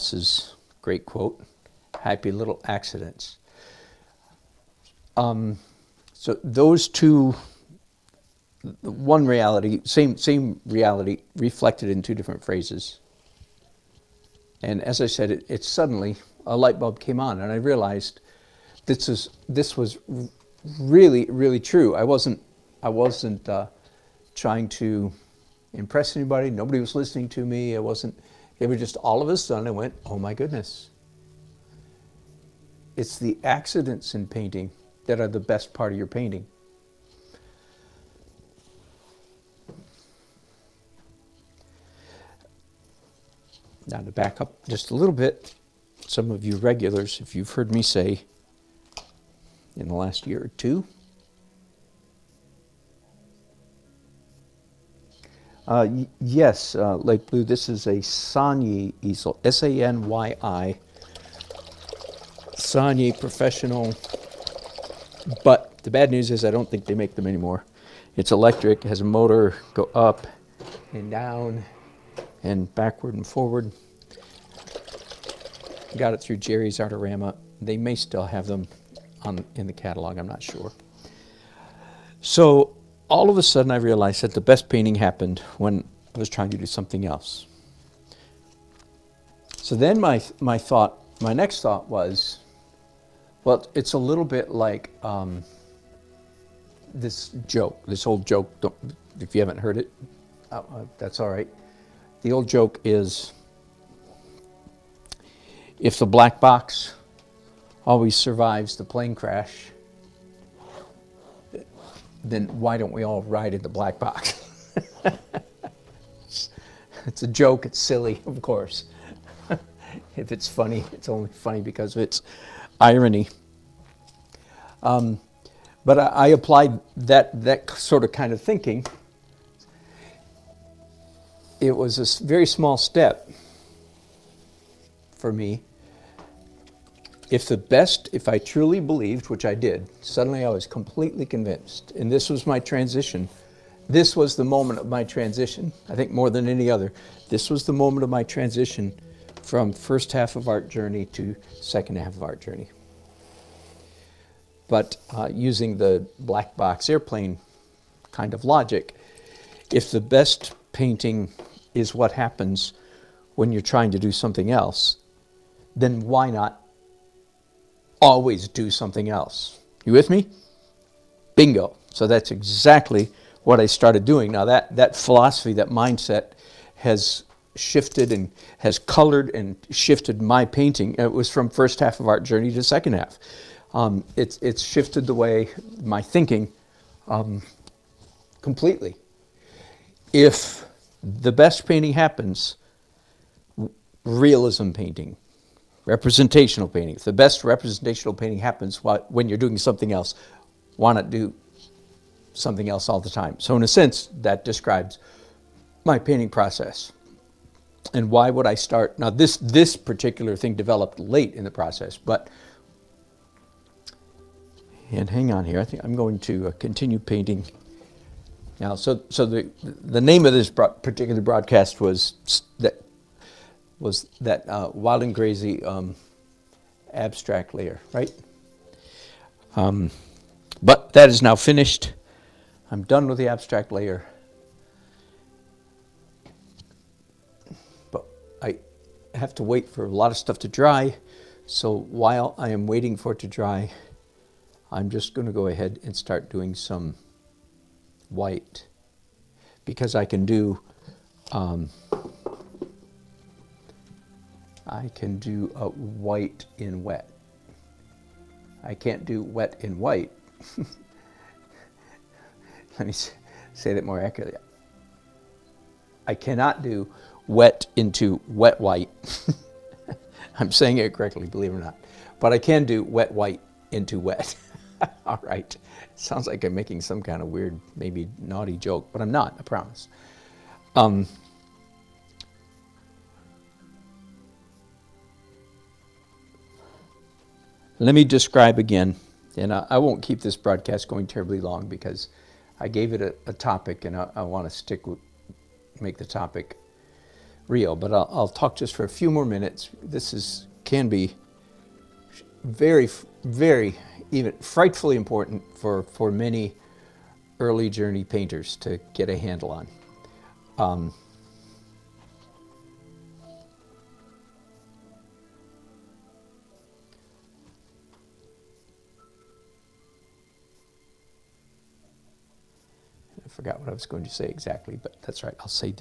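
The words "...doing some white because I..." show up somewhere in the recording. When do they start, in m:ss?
4:06.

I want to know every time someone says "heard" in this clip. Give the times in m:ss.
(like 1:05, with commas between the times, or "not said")
0:47, 1:39.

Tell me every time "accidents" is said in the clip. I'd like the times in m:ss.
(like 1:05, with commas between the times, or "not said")
0:02, 0:33.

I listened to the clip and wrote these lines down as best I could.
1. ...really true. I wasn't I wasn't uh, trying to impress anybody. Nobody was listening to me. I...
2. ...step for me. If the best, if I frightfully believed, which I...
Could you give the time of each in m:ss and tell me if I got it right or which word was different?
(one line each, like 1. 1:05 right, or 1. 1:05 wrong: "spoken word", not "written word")
1. 0:21 right
2. 2:12 wrong: "truly", not "frightfully".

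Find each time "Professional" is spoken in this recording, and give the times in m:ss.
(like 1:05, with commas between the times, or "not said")
1:03.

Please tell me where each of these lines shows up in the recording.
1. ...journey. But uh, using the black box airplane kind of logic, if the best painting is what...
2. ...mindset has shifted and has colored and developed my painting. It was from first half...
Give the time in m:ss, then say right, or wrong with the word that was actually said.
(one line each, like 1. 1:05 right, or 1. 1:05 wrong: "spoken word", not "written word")
1. 2:32 right
2. 2:55 wrong: "shifted", not "developed".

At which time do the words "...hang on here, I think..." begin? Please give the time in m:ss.
3:35.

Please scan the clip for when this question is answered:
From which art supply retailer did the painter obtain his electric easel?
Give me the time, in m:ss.
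1:16.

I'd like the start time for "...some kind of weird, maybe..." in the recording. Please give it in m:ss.
4:36.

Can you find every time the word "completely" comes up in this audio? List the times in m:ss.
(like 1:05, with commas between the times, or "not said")
2:20, 3:08.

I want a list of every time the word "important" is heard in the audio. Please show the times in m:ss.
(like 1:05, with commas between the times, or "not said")
5:04.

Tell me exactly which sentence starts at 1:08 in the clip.
It's electric, has a motor, go up and down, and backward and forward.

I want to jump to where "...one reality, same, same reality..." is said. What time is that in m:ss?
0:08.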